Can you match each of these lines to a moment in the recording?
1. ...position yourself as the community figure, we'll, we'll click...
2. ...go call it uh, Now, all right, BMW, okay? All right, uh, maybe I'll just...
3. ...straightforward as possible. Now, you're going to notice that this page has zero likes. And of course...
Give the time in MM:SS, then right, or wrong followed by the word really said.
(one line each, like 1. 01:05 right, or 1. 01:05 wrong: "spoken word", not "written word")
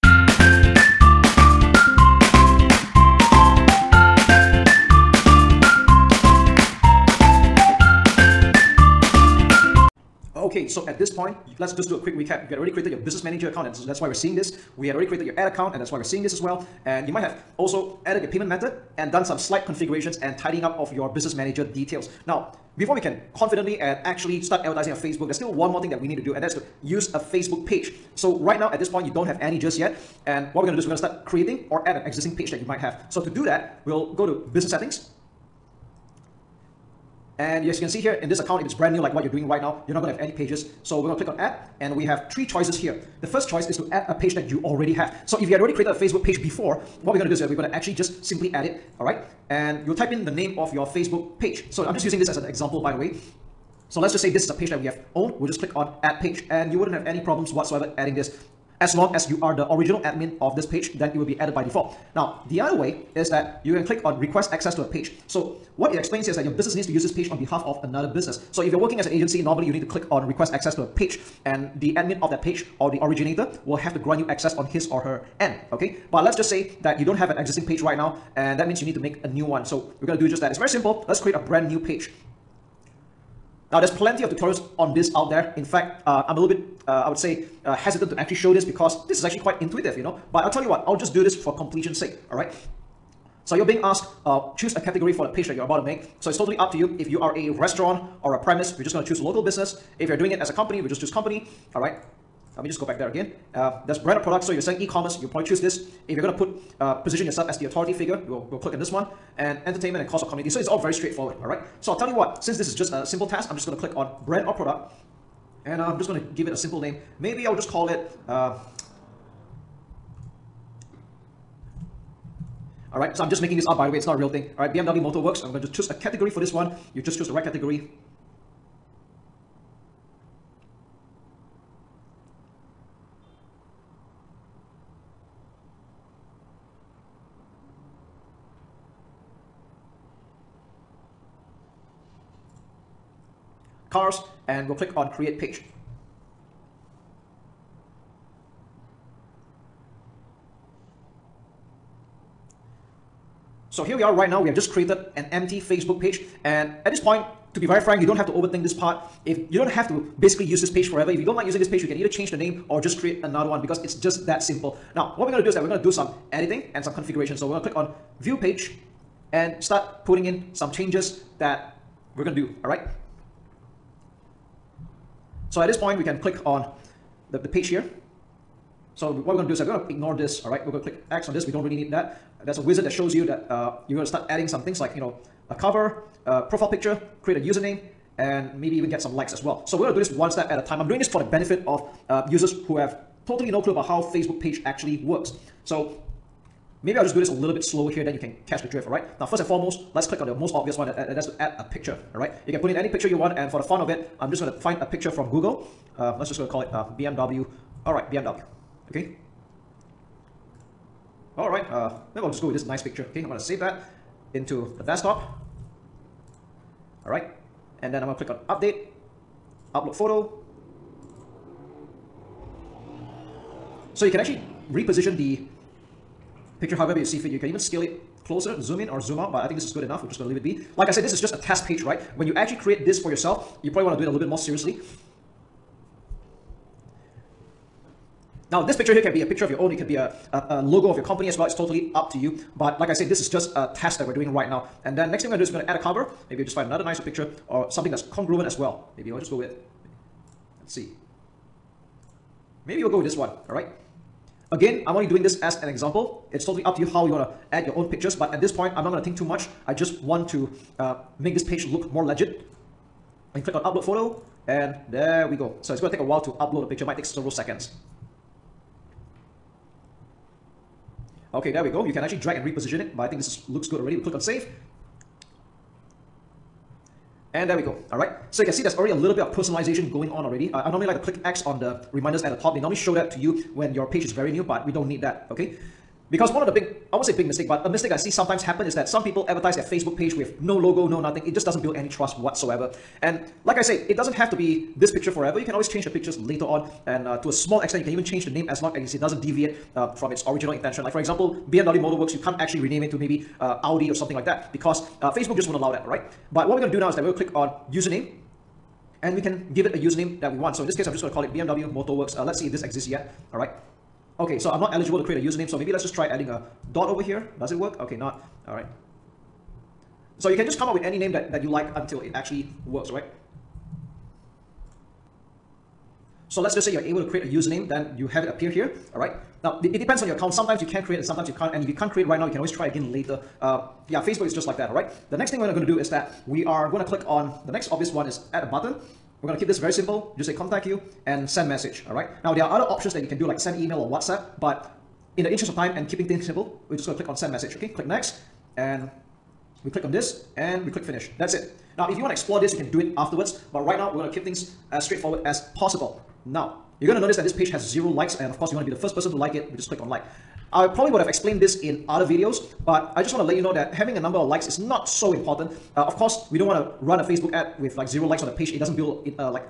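1. 01:46 wrong: "authority", not "community"
2. 03:26 wrong: "BMW", not "Now"
3. 05:54 right.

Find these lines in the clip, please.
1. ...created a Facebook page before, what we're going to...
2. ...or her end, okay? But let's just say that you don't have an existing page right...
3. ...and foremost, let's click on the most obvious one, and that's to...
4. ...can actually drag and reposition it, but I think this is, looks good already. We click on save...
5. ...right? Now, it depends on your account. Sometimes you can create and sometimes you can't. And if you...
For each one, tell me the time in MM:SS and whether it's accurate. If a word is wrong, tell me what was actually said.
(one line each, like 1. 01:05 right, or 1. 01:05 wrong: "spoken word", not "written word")
1. 00:45 right
2. 01:14 right
3. 03:19 right
4. 04:31 right
5. 05:28 right.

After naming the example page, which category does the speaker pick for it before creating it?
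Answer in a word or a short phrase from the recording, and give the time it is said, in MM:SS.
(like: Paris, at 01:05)
Cars, at 02:23.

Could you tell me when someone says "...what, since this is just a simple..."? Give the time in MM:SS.
01:52.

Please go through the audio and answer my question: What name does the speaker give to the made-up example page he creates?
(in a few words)
BMW Motor Works.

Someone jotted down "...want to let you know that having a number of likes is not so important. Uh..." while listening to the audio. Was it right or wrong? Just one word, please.
right.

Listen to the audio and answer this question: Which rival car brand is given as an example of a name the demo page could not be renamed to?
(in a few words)
Audi.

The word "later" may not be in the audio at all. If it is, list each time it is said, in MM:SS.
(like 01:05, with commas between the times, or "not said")
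04:56, 05:32.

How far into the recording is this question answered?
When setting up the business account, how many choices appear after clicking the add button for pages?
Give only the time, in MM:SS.
00:42.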